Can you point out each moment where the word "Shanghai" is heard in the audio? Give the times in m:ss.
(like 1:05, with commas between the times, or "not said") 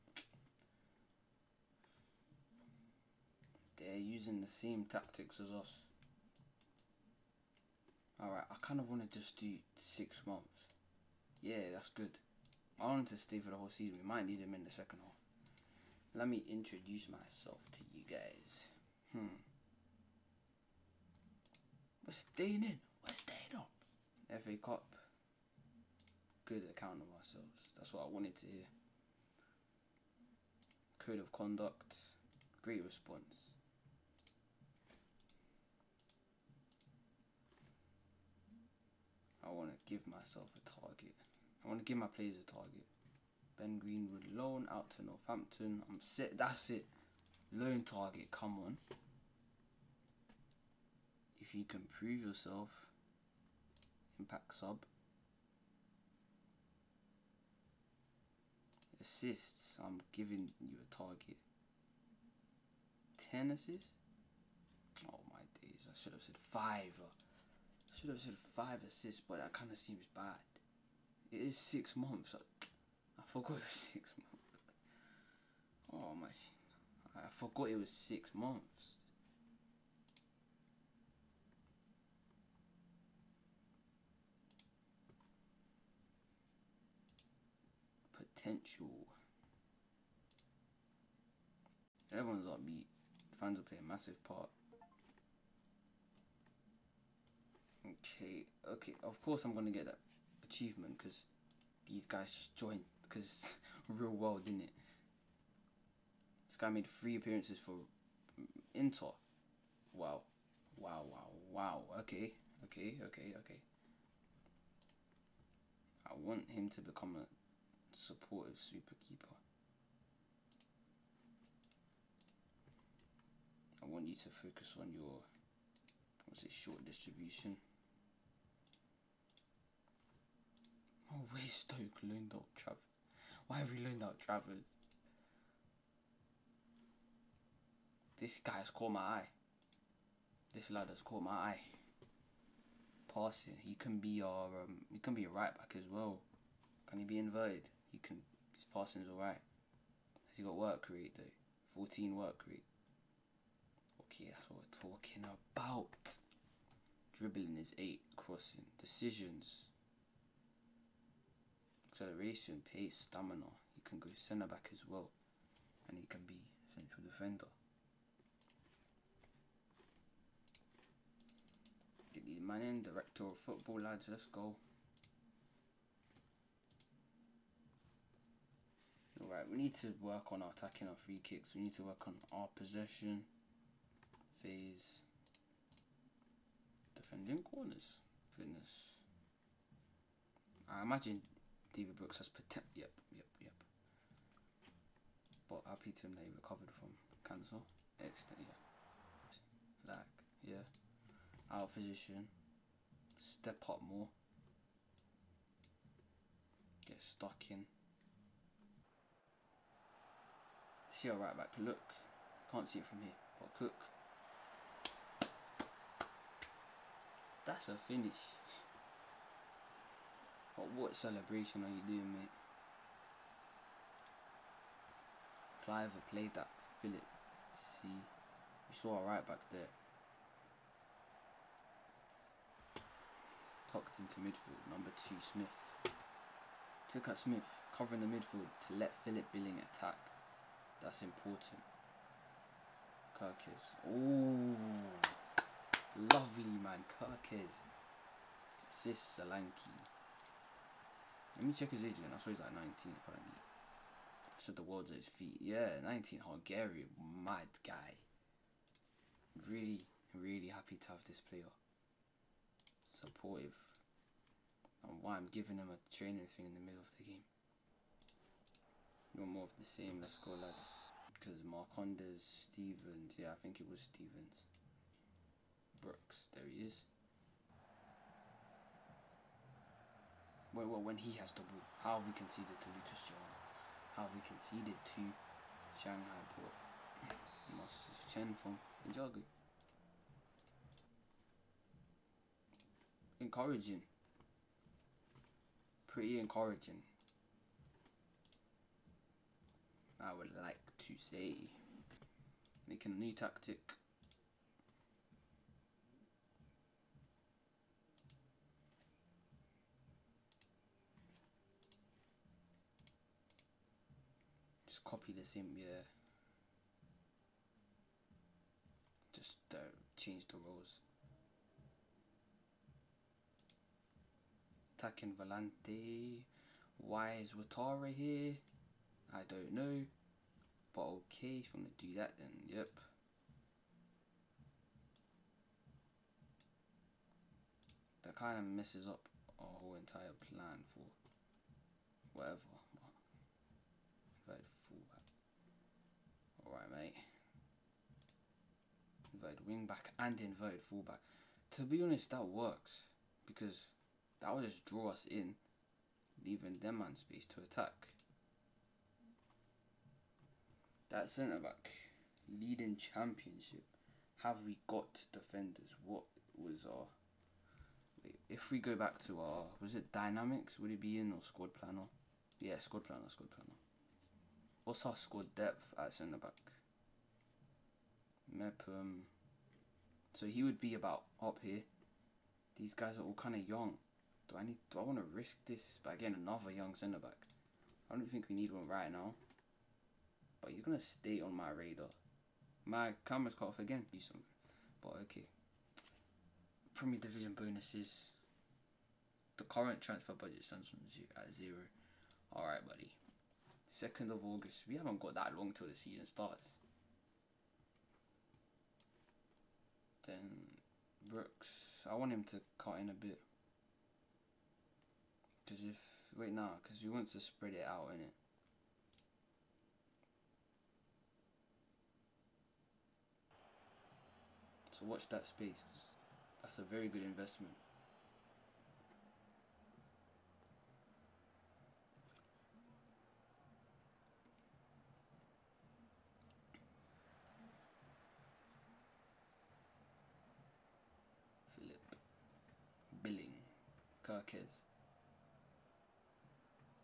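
4:45.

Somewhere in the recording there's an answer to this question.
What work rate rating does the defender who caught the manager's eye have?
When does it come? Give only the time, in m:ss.
2:31.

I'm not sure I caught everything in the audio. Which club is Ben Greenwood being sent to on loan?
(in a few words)
Northampton.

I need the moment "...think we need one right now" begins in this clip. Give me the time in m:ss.
6:28.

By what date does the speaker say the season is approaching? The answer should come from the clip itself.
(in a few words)
2nd of August.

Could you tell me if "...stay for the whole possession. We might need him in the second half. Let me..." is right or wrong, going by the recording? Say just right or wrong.
wrong.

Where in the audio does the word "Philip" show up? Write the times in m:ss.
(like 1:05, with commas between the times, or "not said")
3:46, 3:59.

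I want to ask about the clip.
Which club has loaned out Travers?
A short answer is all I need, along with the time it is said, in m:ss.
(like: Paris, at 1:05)
Stoke, at 2:11.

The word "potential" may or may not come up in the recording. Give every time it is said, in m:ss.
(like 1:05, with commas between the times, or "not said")
1:28, 3:12.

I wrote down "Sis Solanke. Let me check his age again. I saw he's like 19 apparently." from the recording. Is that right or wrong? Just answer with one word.
right.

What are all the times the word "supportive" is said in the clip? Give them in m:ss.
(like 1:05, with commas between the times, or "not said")
1:57, 4:22.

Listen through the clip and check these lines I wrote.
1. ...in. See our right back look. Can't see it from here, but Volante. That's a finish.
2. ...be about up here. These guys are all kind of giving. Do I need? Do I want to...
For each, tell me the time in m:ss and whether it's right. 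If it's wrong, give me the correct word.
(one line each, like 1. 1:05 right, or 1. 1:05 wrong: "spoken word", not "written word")
1. 3:27 wrong: "Cook", not "Volante"
2. 6:20 wrong: "young", not "giving".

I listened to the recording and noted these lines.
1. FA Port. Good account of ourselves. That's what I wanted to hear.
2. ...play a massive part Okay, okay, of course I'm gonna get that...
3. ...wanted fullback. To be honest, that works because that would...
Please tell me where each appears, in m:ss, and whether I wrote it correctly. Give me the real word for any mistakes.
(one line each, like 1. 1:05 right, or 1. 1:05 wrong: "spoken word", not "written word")
1. 0:24 wrong: "Cup", not "Port"
2. 1:33 right
3. 5:50 wrong: "inverted", not "wanted".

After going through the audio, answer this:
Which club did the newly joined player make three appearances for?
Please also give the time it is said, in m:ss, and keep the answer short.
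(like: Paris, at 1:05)
Inter, at 1:48.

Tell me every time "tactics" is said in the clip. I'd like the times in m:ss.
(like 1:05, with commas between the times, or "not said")
0:04, 5:03.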